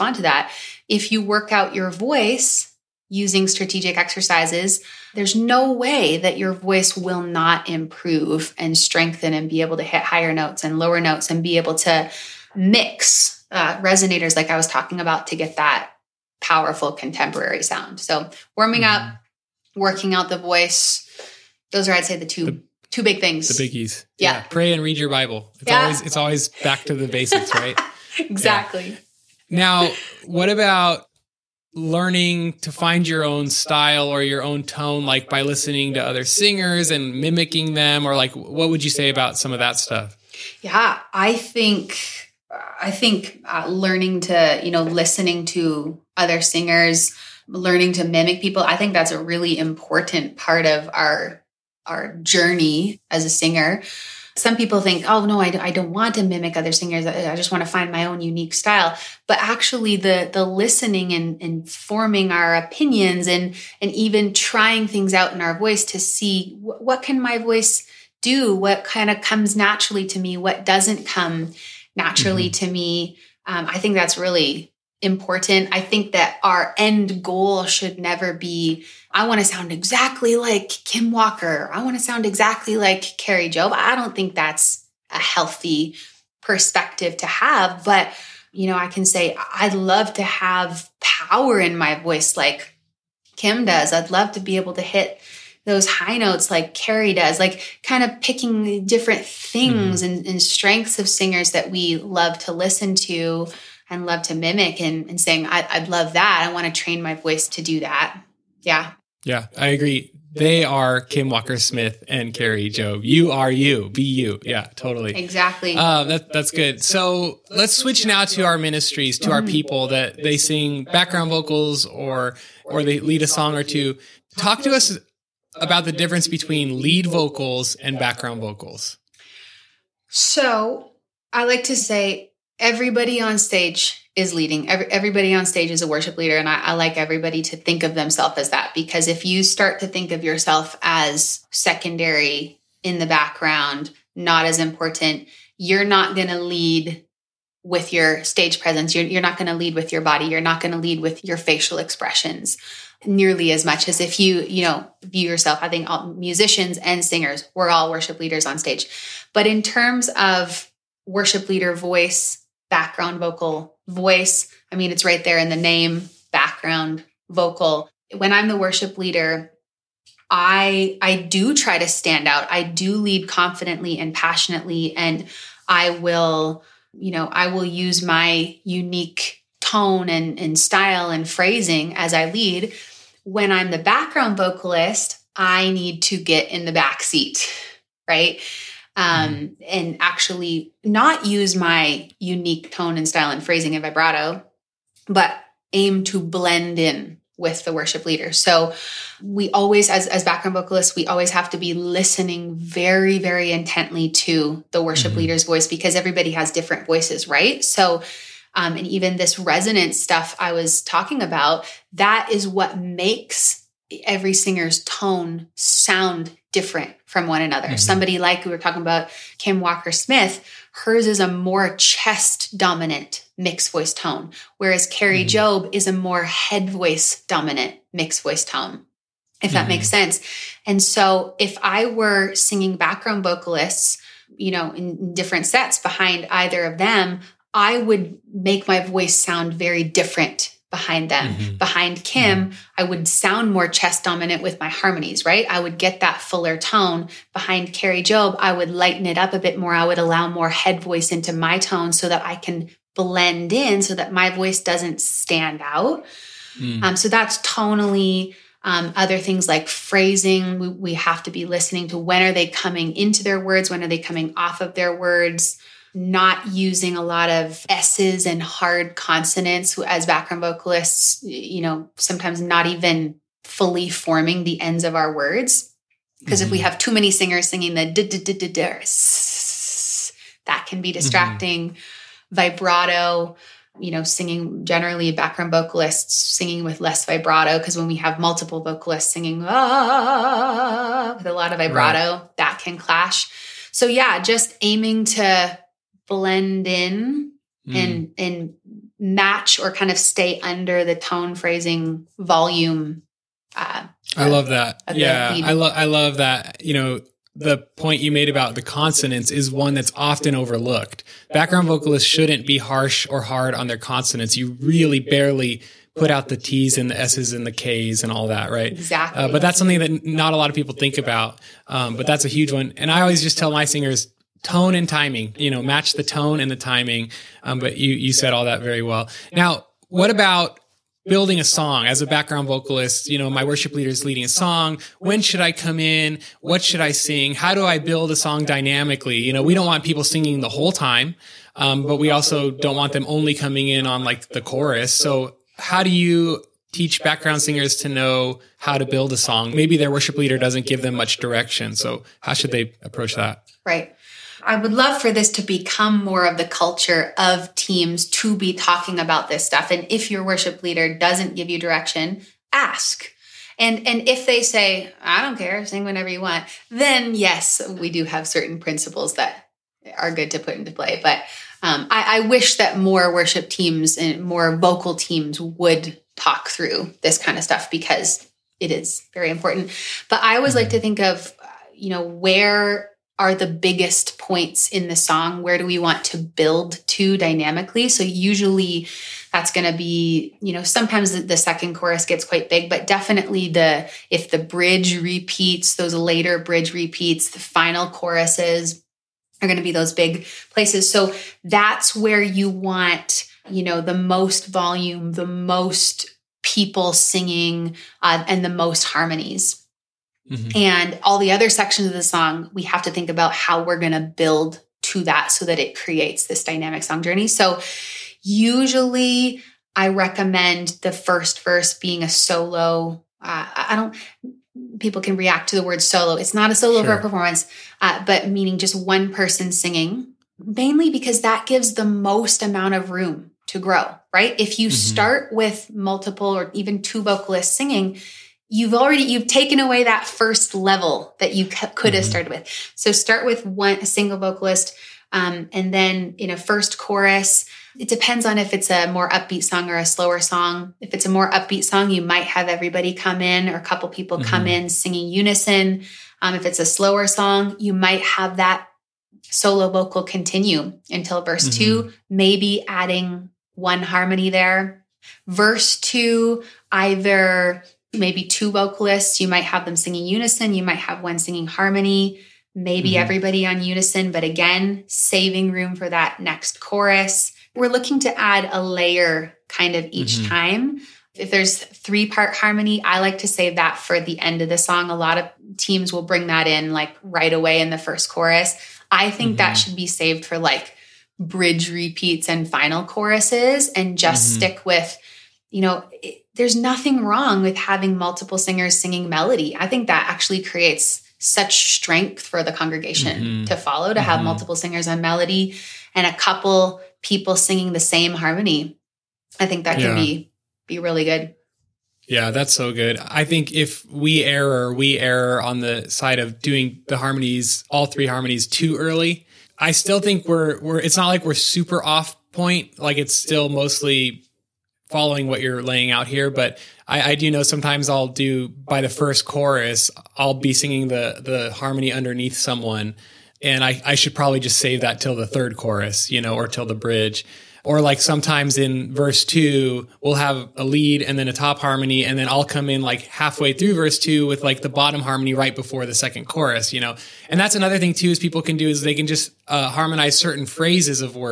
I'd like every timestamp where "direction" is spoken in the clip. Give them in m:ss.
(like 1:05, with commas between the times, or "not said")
5:51, 6:01.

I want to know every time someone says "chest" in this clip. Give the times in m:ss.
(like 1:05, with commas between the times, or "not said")
3:41, 4:03.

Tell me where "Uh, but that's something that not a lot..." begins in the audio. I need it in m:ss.
5:19.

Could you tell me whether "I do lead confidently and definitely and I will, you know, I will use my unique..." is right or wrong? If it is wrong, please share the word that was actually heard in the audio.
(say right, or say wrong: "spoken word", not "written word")
wrong: "passionately", not "definitely".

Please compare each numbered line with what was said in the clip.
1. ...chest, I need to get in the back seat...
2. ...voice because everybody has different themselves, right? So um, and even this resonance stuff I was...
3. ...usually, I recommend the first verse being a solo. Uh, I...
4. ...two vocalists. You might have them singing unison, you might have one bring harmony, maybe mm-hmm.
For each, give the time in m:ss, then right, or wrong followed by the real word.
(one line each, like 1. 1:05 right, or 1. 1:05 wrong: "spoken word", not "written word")
1. 3:04 wrong: "vocalist", not "chest"
2. 3:25 wrong: "voices", not "themselves"
3. 6:58 right
4. 7:48 wrong: "singing", not "bring".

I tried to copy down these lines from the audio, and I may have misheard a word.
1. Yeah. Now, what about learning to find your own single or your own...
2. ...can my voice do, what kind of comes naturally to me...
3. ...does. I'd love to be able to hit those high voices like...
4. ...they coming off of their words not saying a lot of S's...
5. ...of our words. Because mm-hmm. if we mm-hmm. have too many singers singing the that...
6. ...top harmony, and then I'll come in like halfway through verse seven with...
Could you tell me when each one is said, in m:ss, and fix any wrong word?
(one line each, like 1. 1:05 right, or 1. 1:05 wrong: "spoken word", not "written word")
1. 0:29 wrong: "style", not "single"
2. 1:07 right
3. 1:33 wrong: "notes", not "voices"
4. 4:23 wrong: "using", not "saying"
5. 4:34 right
6. 9:01 wrong: "two", not "seven".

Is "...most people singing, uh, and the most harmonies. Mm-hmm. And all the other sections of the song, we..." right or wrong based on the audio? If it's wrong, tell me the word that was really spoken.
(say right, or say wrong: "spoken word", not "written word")
right.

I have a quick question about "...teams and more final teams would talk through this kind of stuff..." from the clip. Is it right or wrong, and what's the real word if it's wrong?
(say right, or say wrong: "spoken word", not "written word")
wrong: "vocal", not "final".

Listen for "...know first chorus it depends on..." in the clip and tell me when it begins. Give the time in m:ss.
7:26.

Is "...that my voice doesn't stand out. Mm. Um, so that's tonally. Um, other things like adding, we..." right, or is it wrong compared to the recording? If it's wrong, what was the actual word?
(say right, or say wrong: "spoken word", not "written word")
wrong: "phrasing", not "adding".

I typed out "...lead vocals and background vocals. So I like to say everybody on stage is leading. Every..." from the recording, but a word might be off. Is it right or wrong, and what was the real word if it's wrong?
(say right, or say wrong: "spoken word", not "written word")
right.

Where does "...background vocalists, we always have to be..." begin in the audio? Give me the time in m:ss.
3:20.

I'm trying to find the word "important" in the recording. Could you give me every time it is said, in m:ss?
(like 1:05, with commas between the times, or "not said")
0:49, 1:15, 2:24, 6:19.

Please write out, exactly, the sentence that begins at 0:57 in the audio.
I, just want to find my own unique style.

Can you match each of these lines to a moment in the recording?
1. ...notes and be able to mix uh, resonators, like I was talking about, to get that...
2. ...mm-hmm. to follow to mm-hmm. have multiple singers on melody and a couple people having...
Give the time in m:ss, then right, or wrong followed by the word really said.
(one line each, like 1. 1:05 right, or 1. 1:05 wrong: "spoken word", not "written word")
1. 0:10 right
2. 8:23 wrong: "singing", not "having".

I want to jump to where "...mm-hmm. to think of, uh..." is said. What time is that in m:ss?
6:20.